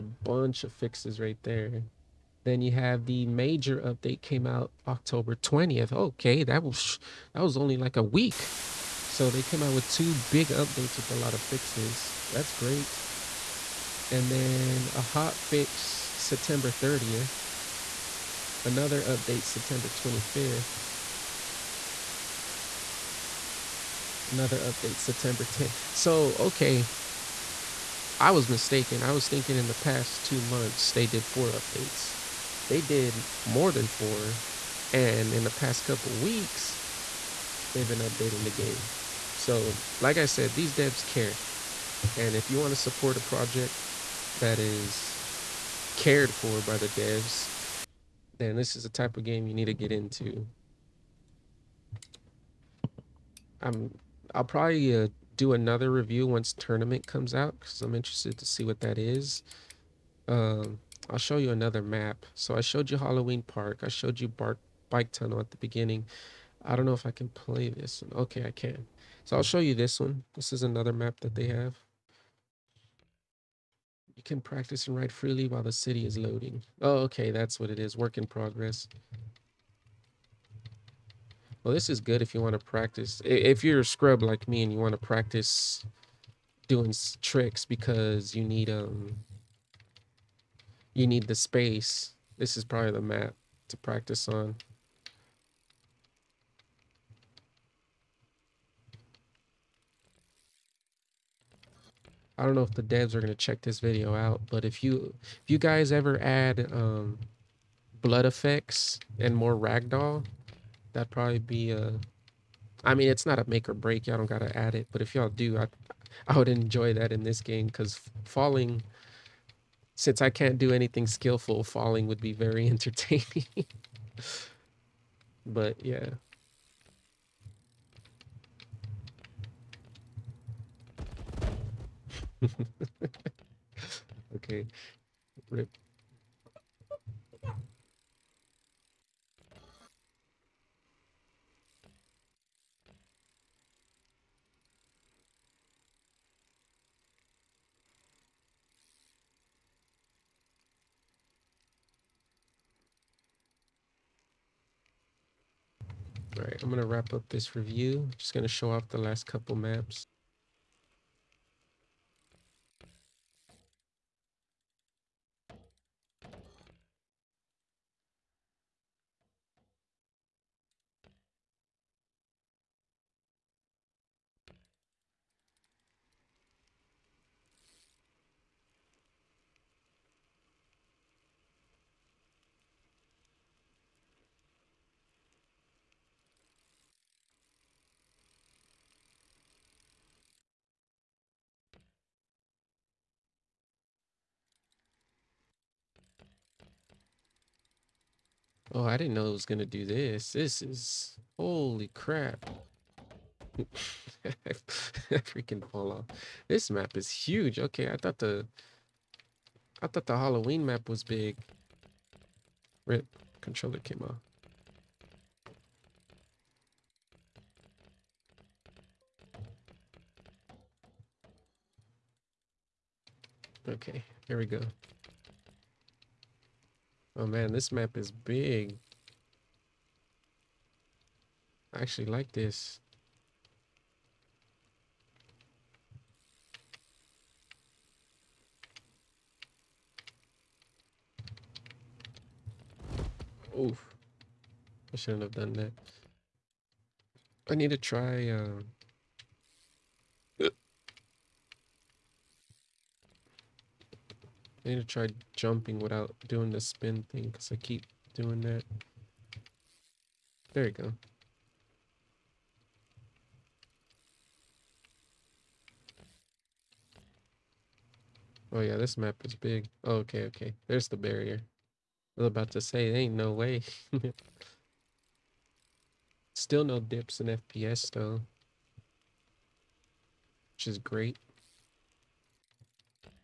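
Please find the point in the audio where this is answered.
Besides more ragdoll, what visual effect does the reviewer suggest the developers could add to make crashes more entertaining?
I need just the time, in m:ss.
1:48.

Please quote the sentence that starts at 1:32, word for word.
This is probably the map to practice on.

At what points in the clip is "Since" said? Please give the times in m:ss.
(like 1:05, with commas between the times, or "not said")
1:59.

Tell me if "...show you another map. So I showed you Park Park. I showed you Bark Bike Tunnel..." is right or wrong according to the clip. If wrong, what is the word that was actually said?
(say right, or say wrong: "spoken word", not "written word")
wrong: "Halloween", not "Park".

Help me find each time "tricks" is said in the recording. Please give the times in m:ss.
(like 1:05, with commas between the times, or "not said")
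1:27.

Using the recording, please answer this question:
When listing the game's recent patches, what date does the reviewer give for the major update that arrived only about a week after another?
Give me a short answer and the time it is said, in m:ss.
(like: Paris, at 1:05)
October 20th, at 0:04.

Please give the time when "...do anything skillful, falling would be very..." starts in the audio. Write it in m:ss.
2:00.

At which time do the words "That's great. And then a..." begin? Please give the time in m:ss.
0:12.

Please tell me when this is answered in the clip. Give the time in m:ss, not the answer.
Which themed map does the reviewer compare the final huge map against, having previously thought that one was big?
3:30.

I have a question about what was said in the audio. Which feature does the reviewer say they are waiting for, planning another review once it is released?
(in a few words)
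tournament.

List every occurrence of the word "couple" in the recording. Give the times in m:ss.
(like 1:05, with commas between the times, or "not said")
0:35, 2:39.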